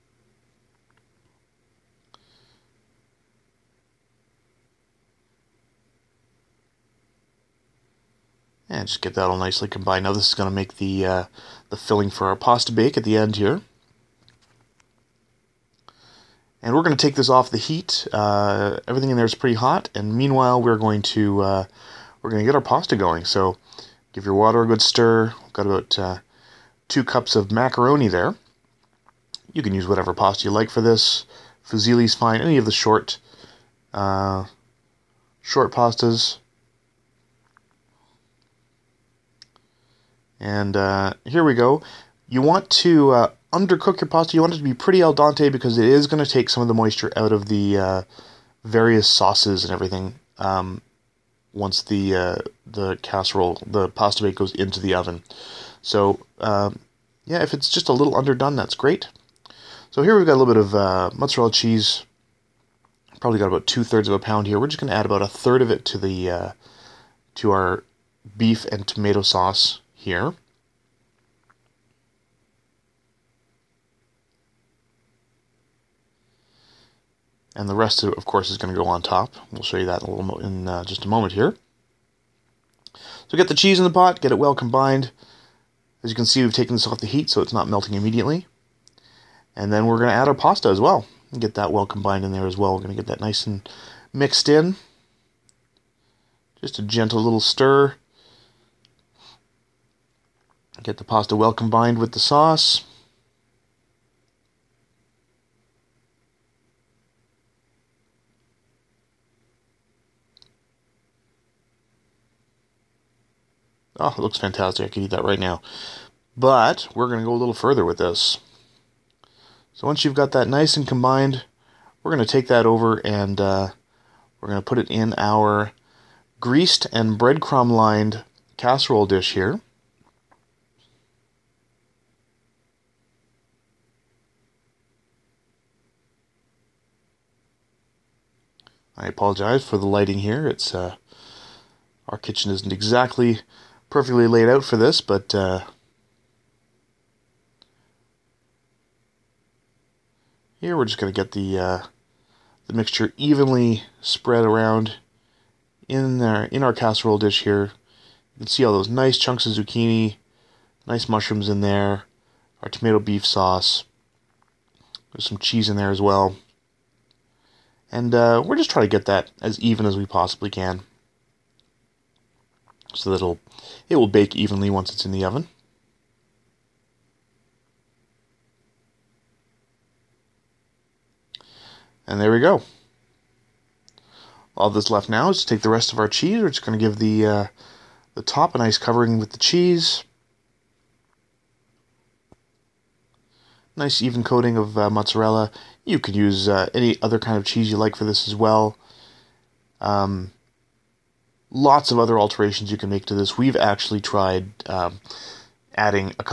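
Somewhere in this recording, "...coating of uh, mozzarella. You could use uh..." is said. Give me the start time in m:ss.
3:14.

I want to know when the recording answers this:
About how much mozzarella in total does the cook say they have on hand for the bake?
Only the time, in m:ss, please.
1:03.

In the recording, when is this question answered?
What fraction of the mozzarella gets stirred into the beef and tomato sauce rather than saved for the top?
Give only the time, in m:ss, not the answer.
1:05.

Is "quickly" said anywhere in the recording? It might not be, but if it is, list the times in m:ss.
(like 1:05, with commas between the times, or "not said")
not said.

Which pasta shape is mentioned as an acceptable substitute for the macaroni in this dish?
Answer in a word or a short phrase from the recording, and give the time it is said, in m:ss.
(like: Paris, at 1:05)
Fusilli, at 0:31.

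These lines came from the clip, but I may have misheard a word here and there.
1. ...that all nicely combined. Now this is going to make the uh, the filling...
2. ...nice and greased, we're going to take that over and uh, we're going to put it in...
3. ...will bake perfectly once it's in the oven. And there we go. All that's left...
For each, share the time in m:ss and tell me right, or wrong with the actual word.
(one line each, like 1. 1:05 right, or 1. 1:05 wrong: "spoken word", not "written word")
1. 0:09 right
2. 2:00 wrong: "combined", not "greased"
3. 2:53 wrong: "evenly", not "perfectly".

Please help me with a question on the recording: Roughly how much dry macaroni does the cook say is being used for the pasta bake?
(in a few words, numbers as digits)
2 cups.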